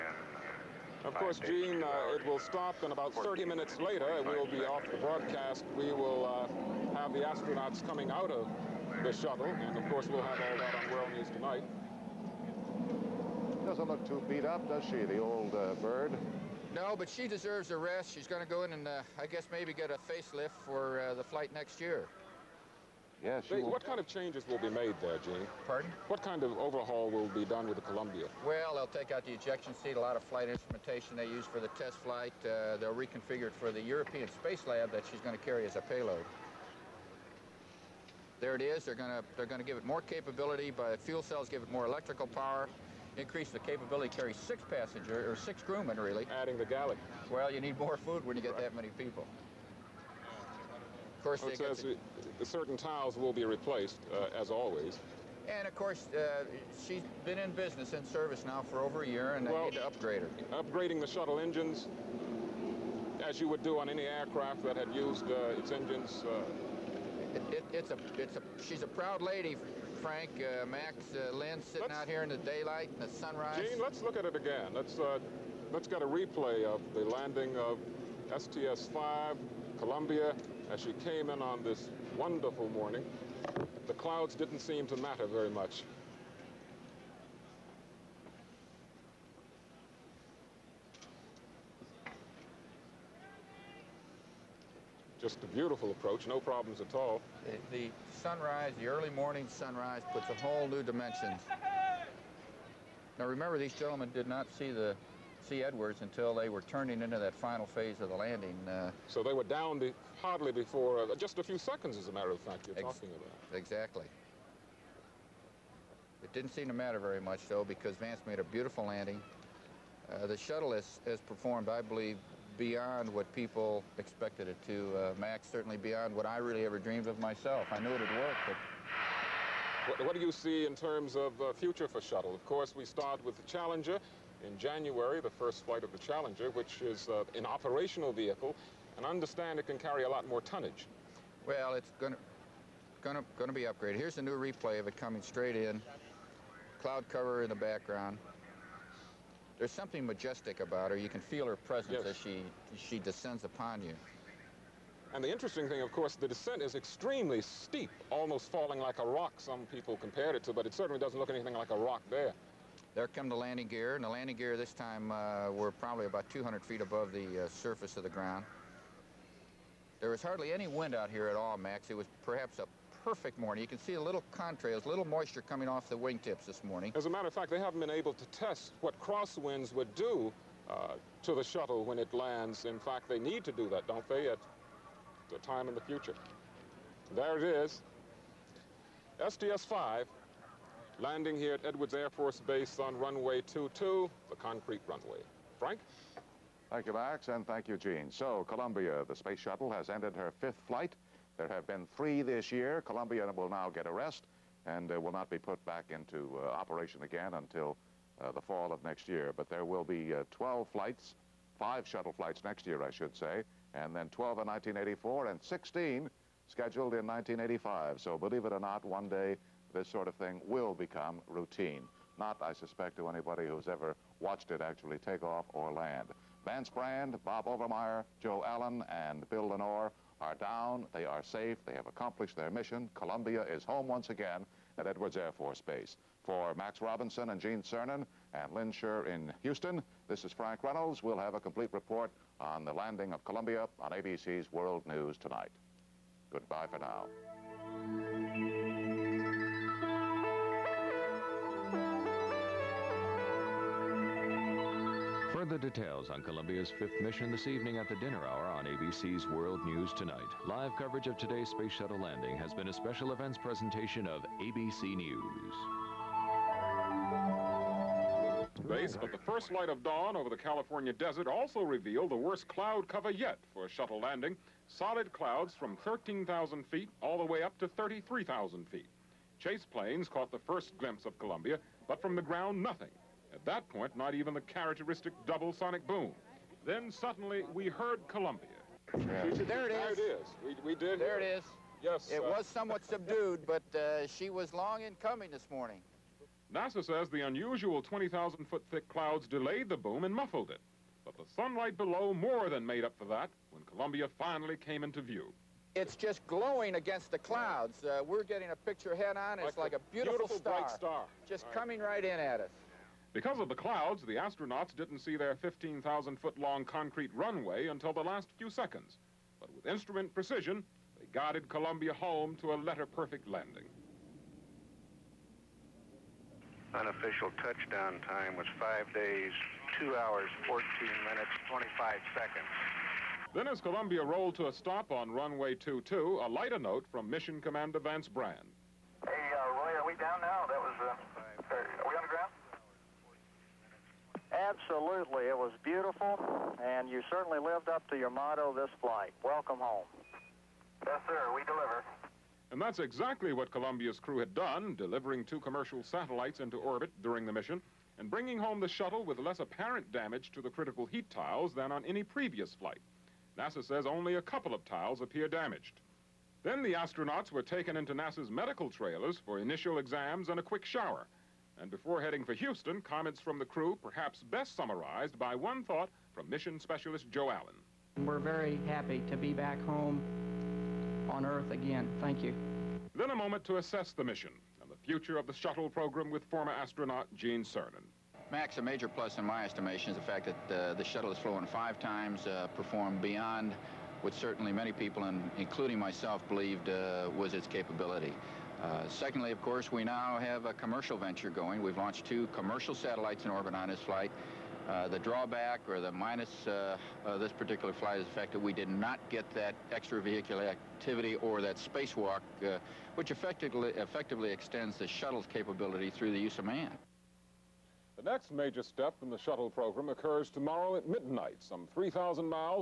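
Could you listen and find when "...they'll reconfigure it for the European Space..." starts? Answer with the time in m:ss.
0:32.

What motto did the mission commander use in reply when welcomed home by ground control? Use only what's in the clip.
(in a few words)
We deliver.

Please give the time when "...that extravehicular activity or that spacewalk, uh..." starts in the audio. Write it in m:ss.
6:49.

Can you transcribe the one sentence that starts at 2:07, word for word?
I knew it would work, but...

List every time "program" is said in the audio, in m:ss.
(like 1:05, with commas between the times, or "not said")
6:25, 6:59.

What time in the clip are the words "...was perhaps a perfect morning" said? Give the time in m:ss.
2:51.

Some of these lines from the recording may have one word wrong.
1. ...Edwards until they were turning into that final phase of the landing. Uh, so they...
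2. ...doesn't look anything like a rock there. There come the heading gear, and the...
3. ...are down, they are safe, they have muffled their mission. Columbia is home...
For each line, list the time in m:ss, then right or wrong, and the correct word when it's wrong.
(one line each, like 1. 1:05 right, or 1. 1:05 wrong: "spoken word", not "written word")
1. 1:45 right
2. 2:40 wrong: "landing", not "heading"
3. 3:50 wrong: "accomplished", not "muffled".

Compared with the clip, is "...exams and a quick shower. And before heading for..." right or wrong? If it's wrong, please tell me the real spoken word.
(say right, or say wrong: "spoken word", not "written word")
right.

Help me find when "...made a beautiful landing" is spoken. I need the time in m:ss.
1:58.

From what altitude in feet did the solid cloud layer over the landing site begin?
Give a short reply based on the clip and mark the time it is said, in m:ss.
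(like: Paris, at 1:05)
13,000, at 4:35.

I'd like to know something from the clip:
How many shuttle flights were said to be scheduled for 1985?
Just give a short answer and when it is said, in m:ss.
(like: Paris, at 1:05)
16, at 3:35.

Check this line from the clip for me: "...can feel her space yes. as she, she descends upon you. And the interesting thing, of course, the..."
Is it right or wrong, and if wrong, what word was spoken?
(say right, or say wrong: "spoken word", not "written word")
wrong: "presence", not "space".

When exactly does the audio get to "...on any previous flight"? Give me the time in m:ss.
6:01.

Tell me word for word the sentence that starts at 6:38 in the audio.
Uh, secondly, of course, we now have a commercial venture going.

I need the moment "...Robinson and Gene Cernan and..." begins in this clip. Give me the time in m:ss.
3:56.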